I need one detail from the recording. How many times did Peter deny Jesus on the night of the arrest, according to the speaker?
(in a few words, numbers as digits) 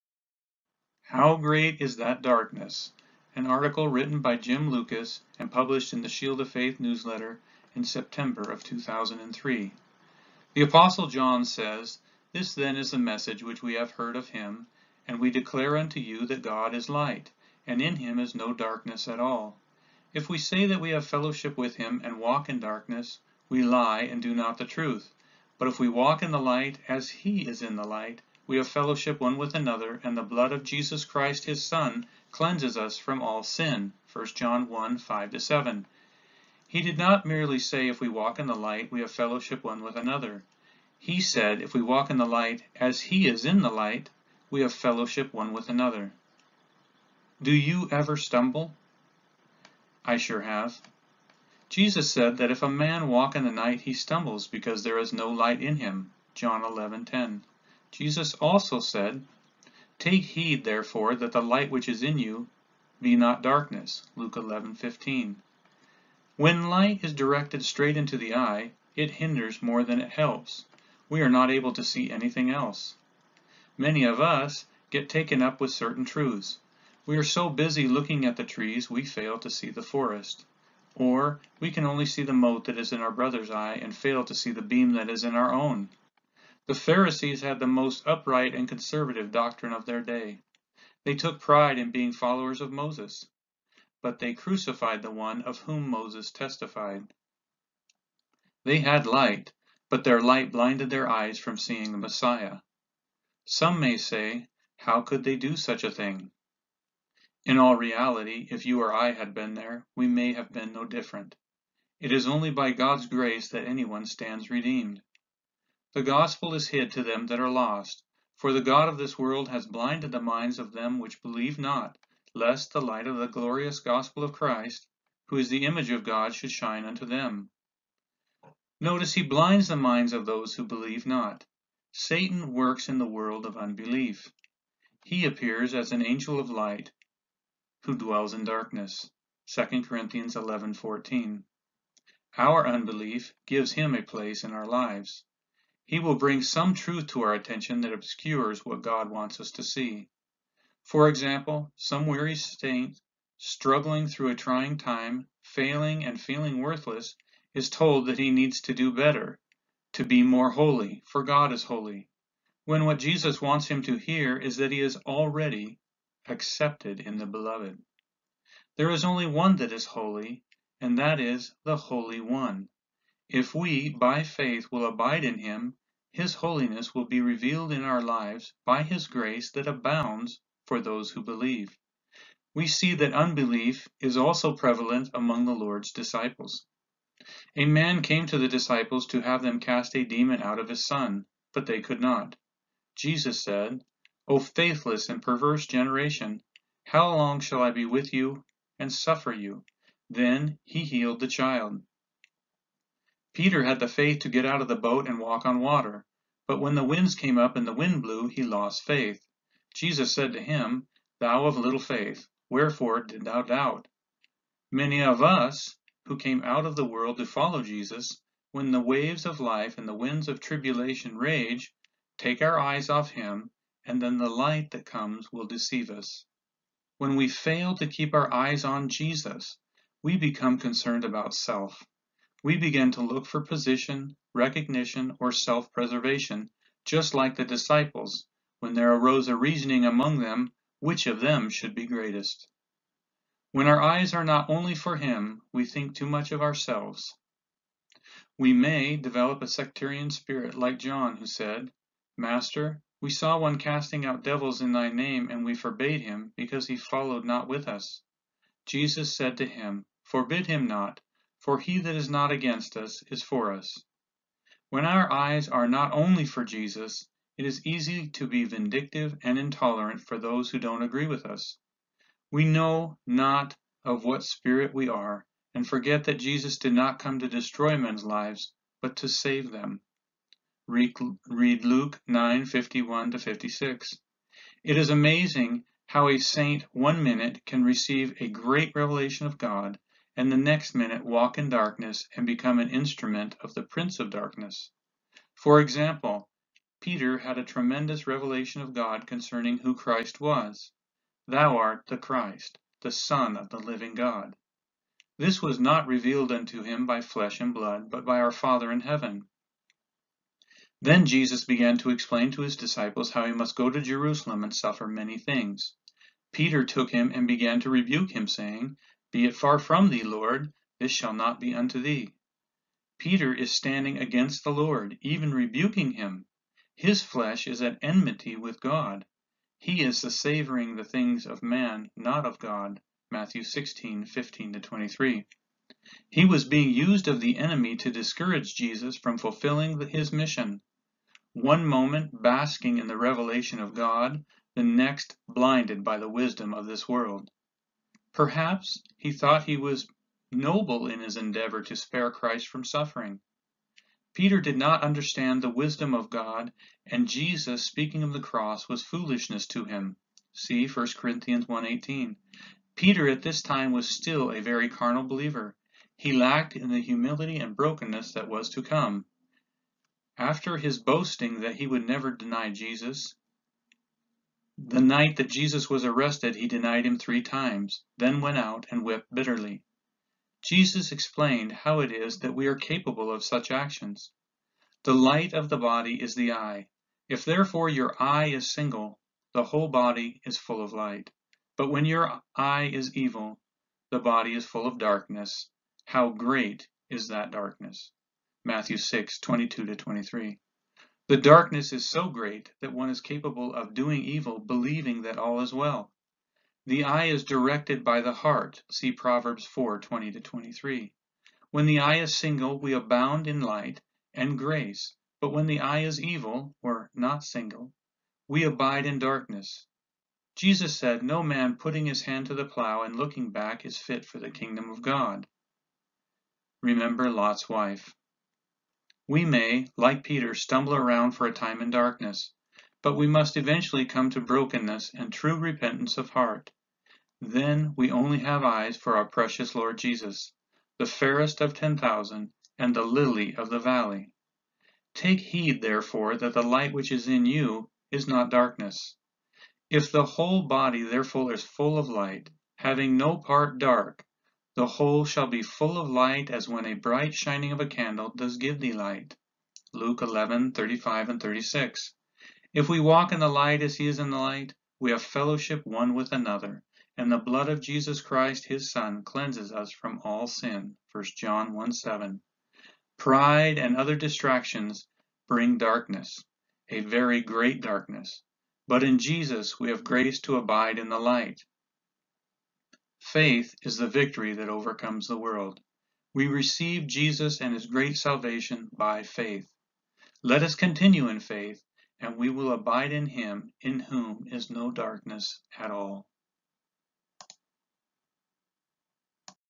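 3.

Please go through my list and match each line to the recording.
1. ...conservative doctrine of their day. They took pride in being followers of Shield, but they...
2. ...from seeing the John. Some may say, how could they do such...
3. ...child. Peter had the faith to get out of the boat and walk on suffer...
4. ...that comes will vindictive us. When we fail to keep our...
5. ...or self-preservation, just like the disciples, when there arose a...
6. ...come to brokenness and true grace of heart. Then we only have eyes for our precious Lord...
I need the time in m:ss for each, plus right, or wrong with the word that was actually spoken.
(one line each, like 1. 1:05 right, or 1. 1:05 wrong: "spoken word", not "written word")
1. 1:28 wrong: "Moses", not "Shield"
2. 1:41 wrong: "Messiah", not "John"
3. 3:21 wrong: "water", not "suffer"
4. 3:44 wrong: "deceive", not "vindictive"
5. 3:55 right
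6. 7:13 wrong: "repentance", not "grace".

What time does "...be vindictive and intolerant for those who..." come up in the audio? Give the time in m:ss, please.
4:28.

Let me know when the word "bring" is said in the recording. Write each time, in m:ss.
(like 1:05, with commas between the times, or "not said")
2:26, 7:55.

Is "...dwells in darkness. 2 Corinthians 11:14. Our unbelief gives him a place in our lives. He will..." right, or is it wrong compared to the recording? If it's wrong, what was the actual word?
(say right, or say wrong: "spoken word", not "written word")
right.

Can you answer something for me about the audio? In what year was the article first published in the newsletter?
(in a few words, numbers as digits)
2003.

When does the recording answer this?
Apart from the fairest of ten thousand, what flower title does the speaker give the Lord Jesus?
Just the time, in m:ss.
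7:22.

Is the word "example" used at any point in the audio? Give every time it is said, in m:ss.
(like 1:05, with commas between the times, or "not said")
2:31, 4:55.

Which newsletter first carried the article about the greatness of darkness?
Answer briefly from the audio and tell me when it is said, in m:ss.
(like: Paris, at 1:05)
Shield of Faith, at 0:06.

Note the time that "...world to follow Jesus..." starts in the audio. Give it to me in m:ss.
3:36.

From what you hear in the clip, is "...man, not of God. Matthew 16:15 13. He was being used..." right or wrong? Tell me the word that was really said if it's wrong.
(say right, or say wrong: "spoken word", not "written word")
wrong: "23", not "13".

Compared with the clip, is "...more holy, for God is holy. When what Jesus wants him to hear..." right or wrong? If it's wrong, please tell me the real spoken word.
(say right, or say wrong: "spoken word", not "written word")
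right.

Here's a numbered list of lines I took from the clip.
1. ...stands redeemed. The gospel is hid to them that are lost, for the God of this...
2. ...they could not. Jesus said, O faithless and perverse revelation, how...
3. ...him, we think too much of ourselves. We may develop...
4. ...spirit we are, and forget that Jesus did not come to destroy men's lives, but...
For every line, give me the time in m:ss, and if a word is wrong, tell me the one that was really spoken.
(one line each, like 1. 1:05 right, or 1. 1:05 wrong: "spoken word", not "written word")
1. 1:54 right
2. 3:11 wrong: "generation", not "revelation"
3. 4:04 right
4. 4:34 right.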